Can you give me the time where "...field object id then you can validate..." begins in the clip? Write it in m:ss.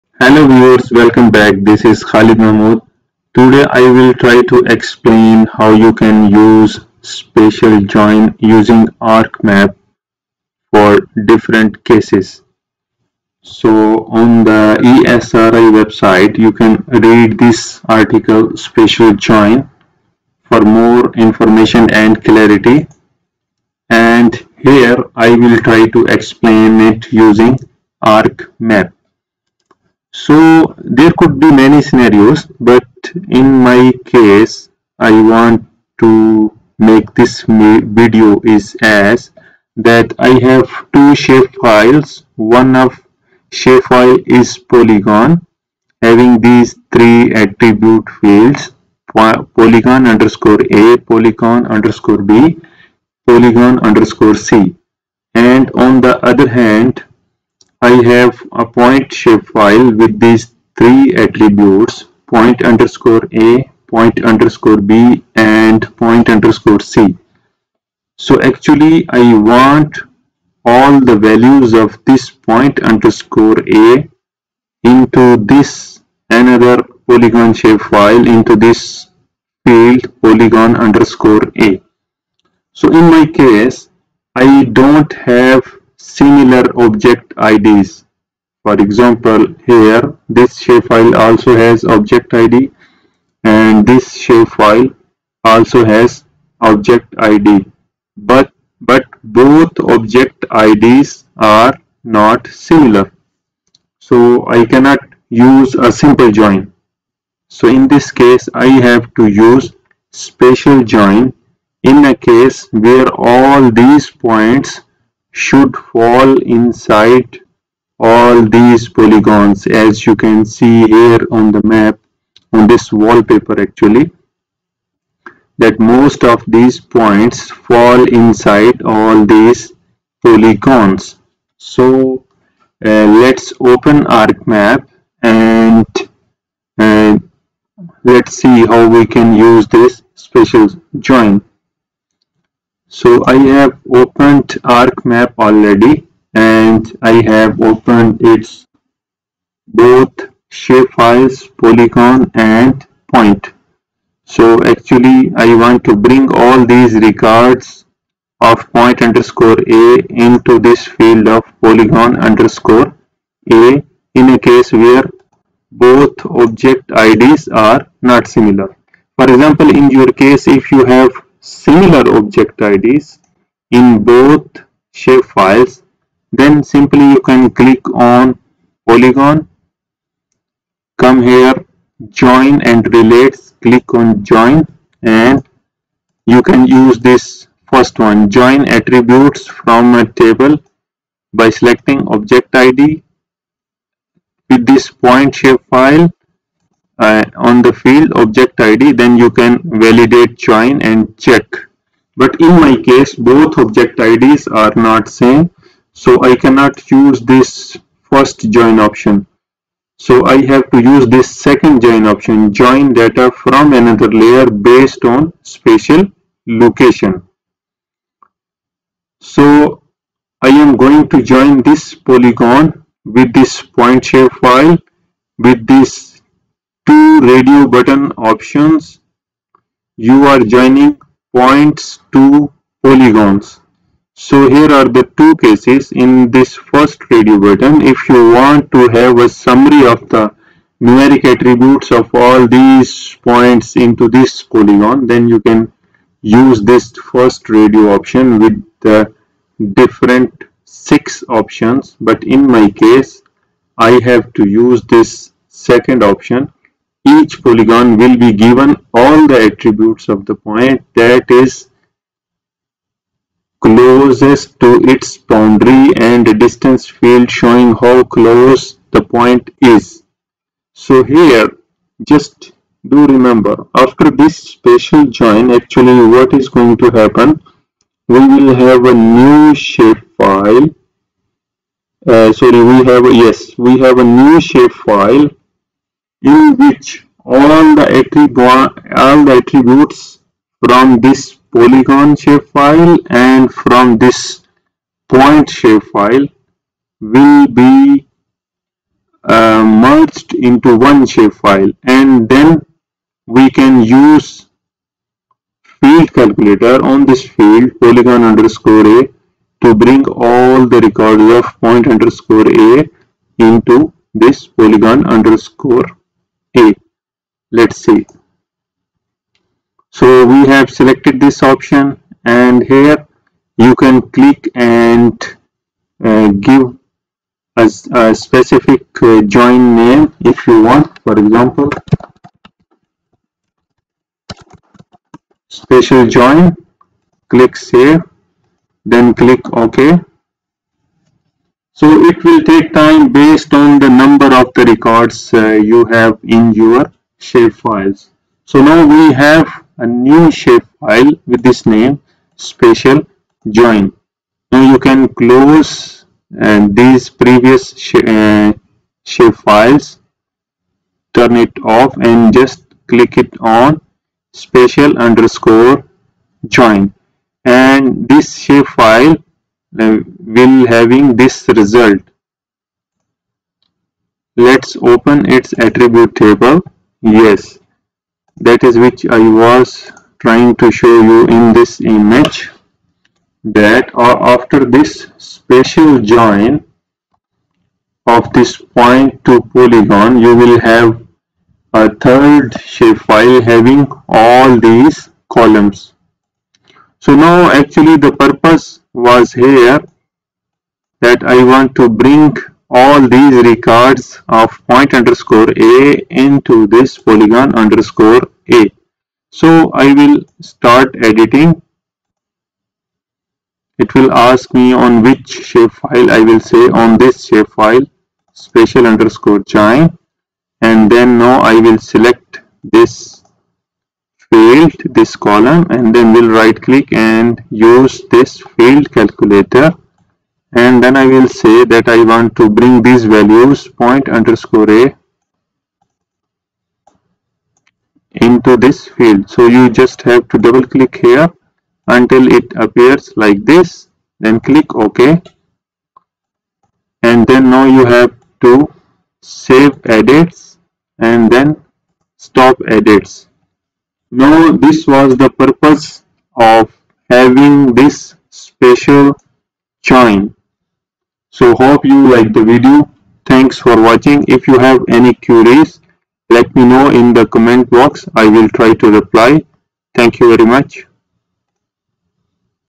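3:17.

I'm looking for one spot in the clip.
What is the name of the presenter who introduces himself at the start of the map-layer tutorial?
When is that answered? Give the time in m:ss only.
0:02.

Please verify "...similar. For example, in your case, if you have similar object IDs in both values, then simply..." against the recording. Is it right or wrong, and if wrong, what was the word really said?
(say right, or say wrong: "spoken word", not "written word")
wrong: "shapefiles", not "values".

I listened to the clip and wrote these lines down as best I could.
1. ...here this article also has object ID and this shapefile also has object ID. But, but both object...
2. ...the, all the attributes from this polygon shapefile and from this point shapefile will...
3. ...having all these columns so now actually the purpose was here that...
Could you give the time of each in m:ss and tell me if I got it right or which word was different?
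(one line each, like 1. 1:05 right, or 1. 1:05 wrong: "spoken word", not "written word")
1. 1:29 wrong: "shapefile", not "article"
2. 4:47 right
3. 6:33 right.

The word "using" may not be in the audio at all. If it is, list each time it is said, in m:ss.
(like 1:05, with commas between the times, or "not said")
0:08, 0:27.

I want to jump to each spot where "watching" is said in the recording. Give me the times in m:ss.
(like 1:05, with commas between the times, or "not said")
7:43.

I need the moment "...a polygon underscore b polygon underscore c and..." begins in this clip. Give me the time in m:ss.
0:50.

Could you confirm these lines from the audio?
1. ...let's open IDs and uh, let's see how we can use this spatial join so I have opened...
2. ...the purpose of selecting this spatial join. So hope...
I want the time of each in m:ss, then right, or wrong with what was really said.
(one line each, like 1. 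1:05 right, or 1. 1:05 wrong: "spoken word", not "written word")
1. 2:13 wrong: "ArcMap", not "IDs"
2. 7:35 wrong: "having", not "selecting".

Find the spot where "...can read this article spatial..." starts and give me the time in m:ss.
0:16.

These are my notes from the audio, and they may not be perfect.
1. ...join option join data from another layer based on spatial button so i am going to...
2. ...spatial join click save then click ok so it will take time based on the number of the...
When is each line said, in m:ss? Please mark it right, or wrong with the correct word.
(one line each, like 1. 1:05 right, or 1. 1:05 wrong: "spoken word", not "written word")
1. 3:31 wrong: "location", not "button"
2. 5:35 right.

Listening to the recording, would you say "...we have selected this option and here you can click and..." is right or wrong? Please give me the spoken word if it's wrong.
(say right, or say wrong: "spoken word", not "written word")
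right.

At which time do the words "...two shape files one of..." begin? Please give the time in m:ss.
0:40.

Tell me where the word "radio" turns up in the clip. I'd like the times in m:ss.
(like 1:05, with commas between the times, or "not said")
3:47, 3:57, 4:07.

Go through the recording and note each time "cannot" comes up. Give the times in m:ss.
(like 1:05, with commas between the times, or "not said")
1:44, 3:26.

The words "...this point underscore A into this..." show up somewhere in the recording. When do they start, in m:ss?
1:12.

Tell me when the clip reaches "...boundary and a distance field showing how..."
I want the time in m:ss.
4:25.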